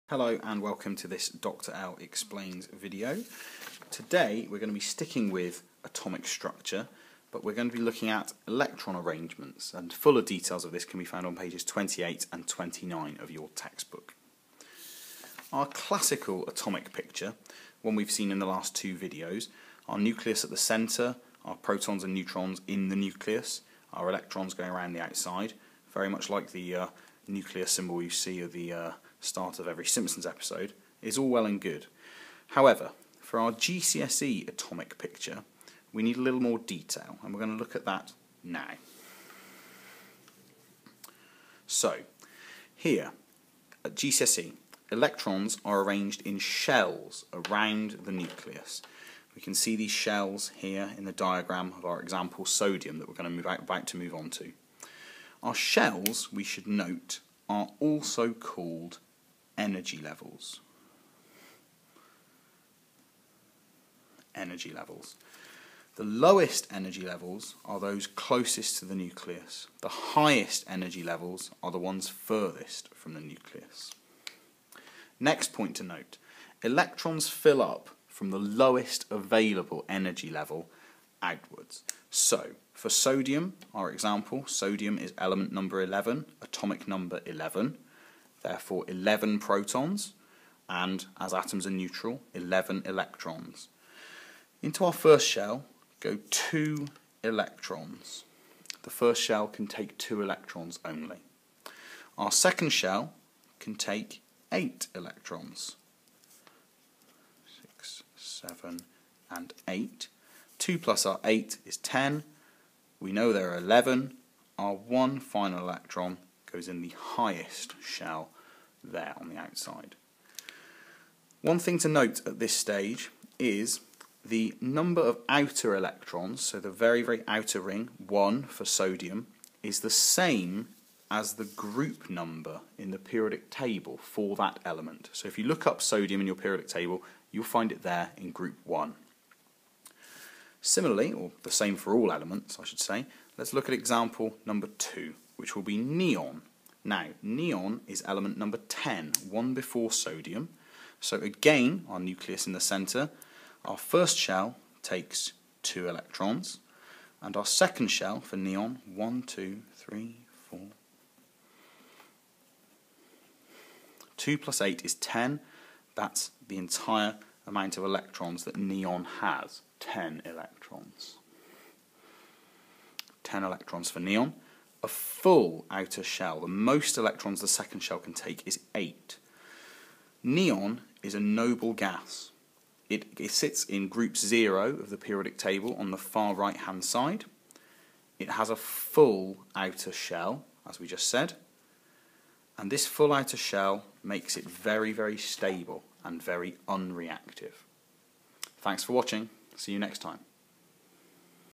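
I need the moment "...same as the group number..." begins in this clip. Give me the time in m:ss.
2:09.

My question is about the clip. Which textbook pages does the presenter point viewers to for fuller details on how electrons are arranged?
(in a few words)
28 and 29.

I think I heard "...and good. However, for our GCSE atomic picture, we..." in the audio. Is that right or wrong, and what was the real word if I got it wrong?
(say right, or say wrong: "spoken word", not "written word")
right.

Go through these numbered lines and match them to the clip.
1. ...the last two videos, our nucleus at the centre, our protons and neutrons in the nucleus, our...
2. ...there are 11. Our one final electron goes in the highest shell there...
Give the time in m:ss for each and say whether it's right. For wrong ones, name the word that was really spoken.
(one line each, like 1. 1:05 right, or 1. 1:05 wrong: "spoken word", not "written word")
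1. 0:18 right
2. 1:53 right.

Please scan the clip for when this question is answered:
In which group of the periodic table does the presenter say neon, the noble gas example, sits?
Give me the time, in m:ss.
3:03.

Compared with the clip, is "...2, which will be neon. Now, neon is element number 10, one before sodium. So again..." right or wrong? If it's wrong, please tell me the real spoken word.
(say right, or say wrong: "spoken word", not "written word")
right.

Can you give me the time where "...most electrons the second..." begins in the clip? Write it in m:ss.
2:56.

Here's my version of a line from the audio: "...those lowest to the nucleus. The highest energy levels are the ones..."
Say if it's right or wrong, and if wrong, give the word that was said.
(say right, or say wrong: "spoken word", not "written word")
wrong: "closest", not "lowest".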